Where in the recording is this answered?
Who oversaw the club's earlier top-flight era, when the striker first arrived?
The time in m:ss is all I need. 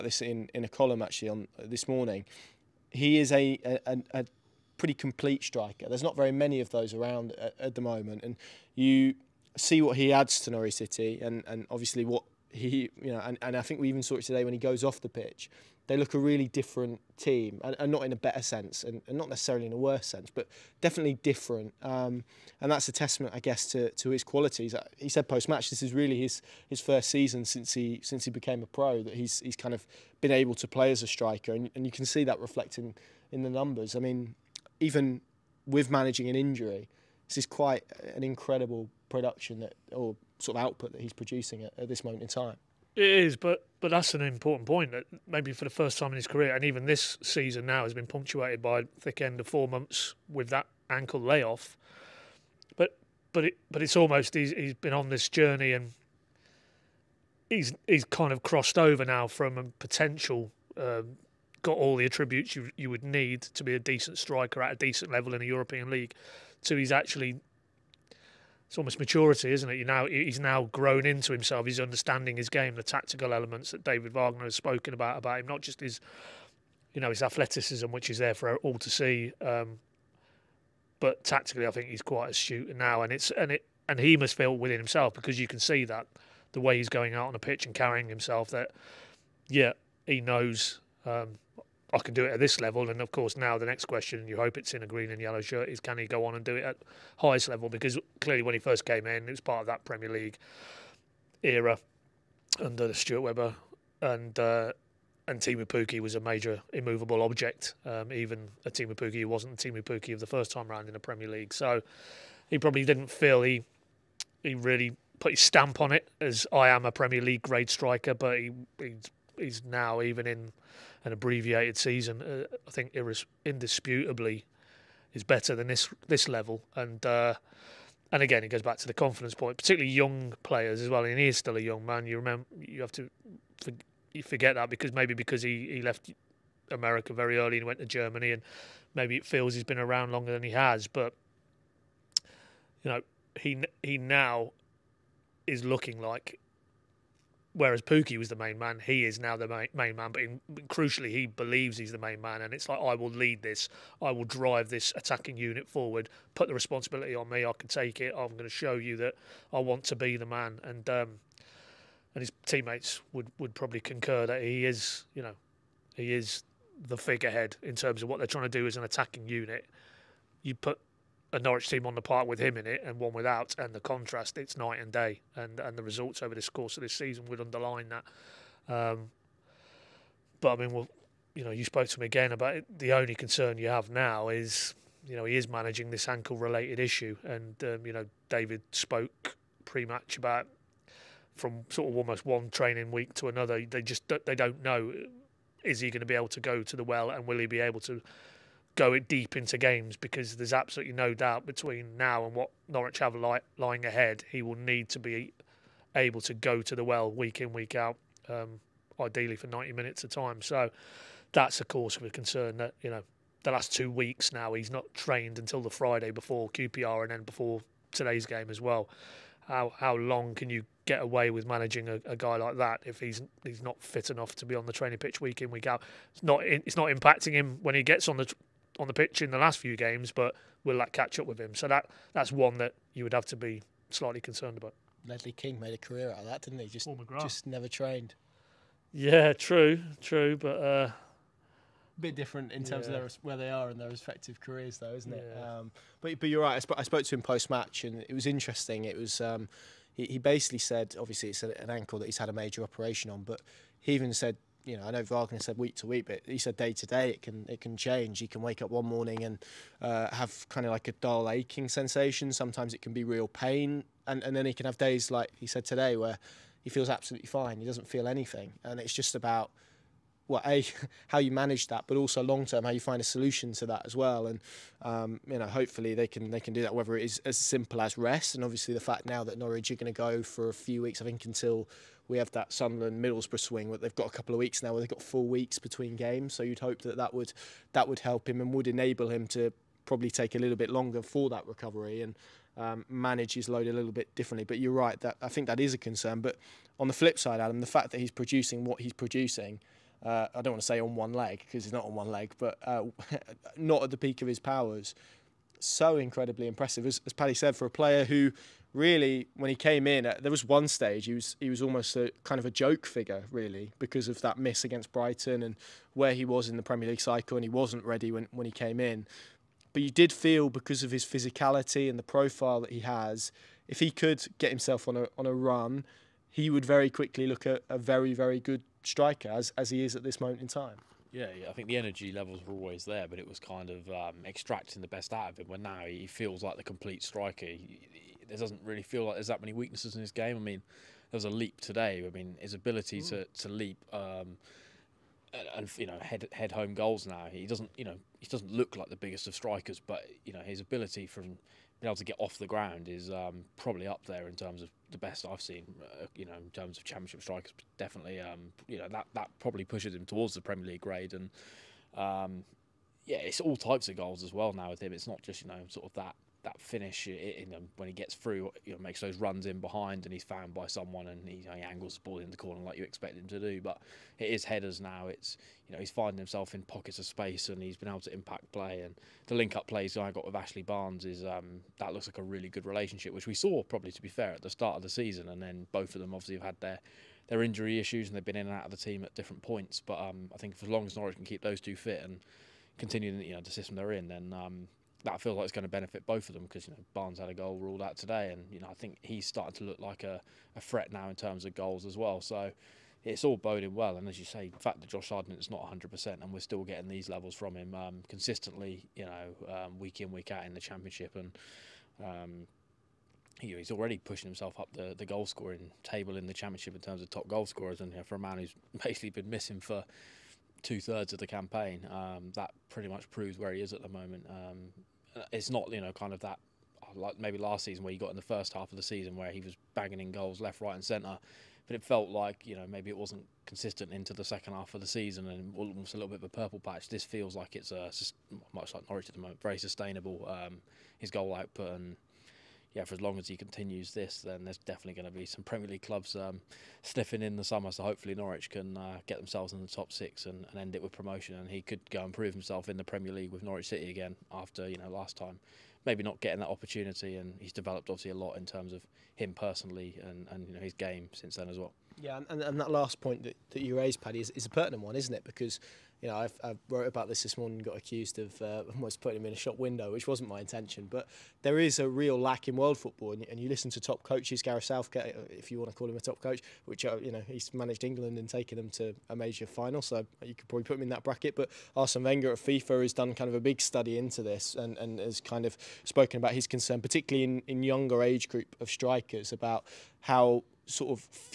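1:42.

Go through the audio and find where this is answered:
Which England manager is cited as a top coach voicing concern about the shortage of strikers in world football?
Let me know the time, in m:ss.
7:54.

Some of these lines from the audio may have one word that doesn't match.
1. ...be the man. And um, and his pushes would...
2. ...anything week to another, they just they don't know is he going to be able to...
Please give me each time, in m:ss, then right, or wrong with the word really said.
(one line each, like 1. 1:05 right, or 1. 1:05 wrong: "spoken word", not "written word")
1. 2:39 wrong: "teammates", not "pushes"
2. 3:12 wrong: "training", not "anything".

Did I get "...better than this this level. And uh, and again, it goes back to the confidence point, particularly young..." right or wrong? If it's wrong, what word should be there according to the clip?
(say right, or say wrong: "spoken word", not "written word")
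right.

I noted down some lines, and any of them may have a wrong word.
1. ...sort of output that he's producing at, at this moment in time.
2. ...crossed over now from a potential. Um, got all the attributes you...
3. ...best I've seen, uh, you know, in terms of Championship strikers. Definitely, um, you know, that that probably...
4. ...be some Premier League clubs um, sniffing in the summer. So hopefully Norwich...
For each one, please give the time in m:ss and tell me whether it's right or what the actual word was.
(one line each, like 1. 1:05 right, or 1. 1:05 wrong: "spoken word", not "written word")
1. 0:40 right
2. 0:58 right
3. 5:54 right
4. 7:25 right.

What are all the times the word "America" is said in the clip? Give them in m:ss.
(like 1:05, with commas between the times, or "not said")
2:16.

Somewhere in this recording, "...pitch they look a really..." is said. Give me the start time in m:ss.
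0:15.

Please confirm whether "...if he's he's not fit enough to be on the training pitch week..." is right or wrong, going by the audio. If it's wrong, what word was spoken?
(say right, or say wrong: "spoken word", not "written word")
right.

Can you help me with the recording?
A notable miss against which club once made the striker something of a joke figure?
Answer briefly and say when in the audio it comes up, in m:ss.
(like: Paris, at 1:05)
Brighton, at 5:14.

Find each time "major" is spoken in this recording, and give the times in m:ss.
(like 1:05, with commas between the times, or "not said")
1:46, 4:12, 7:59.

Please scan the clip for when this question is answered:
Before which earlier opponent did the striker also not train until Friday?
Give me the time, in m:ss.
3:36.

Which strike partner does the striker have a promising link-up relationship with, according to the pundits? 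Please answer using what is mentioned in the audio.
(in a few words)
Ashley Barnes.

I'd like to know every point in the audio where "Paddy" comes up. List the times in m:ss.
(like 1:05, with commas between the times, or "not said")
5:07, 7:43.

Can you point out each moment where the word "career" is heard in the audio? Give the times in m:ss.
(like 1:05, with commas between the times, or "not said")
0:46, 3:55, 4:04.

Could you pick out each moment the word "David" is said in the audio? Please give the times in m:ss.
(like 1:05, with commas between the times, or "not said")
1:13, 3:08.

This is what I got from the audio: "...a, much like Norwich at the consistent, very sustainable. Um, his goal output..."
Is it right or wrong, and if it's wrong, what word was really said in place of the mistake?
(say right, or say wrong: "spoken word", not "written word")
wrong: "moment", not "consistent".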